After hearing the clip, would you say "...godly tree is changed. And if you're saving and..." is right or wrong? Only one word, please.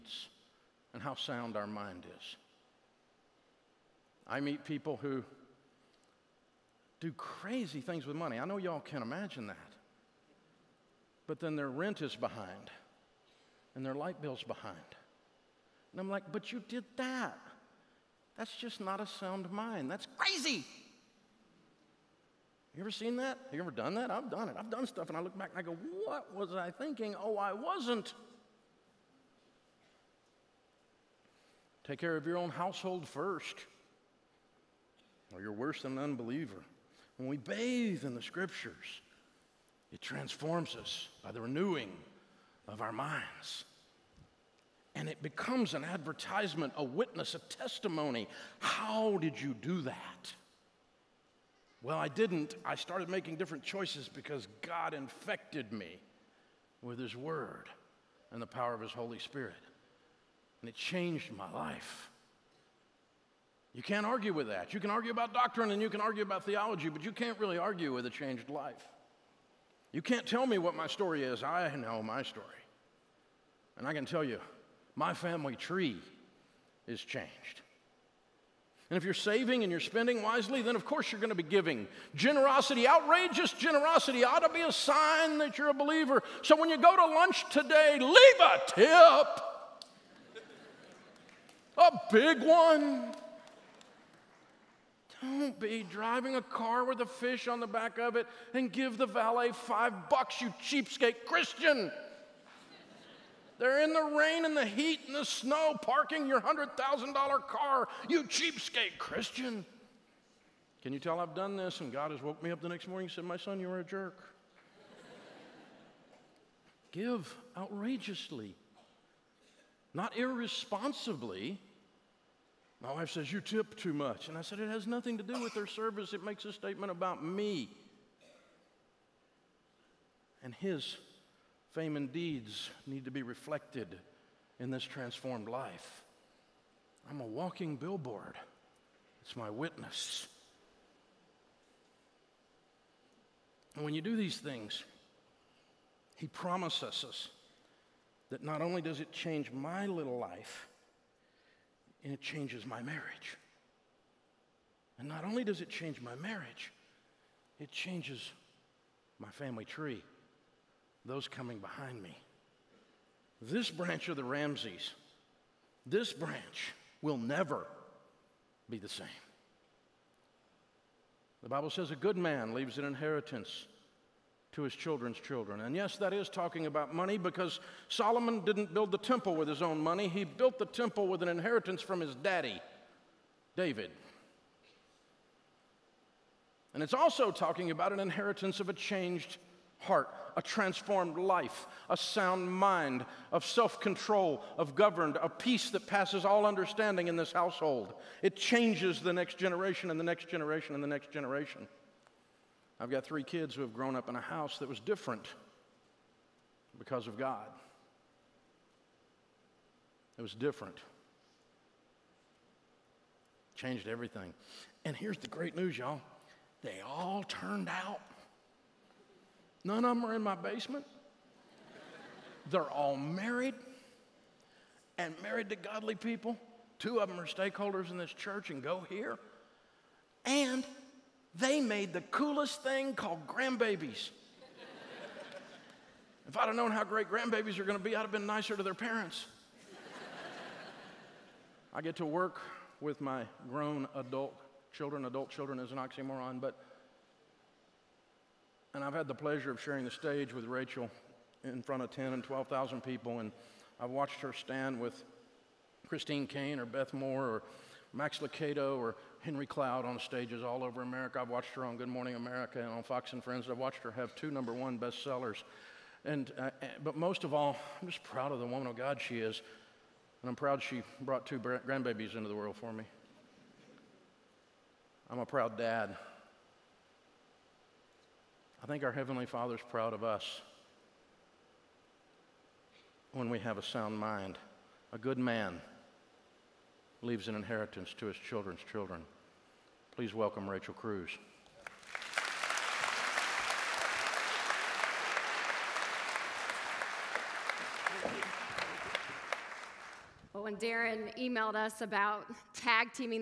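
wrong.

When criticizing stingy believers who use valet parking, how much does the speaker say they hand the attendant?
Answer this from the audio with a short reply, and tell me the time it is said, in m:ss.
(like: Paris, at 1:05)
$5, at 1:39.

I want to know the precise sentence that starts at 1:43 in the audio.
They're in the rain and the heat and the snow parking your $100,000 car, you cheapskate Christian.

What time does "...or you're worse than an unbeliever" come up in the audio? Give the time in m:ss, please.
0:35.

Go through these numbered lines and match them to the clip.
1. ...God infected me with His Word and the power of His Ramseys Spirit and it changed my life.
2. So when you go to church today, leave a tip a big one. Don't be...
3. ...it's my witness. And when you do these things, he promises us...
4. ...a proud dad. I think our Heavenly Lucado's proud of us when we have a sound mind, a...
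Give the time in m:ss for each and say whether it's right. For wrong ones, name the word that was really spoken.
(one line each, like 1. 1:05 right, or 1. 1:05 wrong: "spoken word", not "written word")
1. 0:54 wrong: "Holy", not "Ramseys"
2. 1:26 wrong: "lunch", not "church"
3. 2:19 right
4. 4:35 wrong: "Father", not "Lucado".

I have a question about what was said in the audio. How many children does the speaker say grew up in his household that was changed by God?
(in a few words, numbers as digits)
3.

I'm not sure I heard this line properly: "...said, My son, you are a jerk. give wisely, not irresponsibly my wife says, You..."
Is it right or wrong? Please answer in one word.
wrong.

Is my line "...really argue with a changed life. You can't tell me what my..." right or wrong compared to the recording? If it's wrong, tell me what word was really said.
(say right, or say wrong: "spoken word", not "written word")
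right.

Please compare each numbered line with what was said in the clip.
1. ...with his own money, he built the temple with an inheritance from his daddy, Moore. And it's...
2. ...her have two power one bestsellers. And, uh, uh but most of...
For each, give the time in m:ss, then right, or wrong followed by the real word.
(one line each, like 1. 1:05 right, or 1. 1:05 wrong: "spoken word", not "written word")
1. 2:59 wrong: "David", not "Moore"
2. 4:23 wrong: "number", not "power".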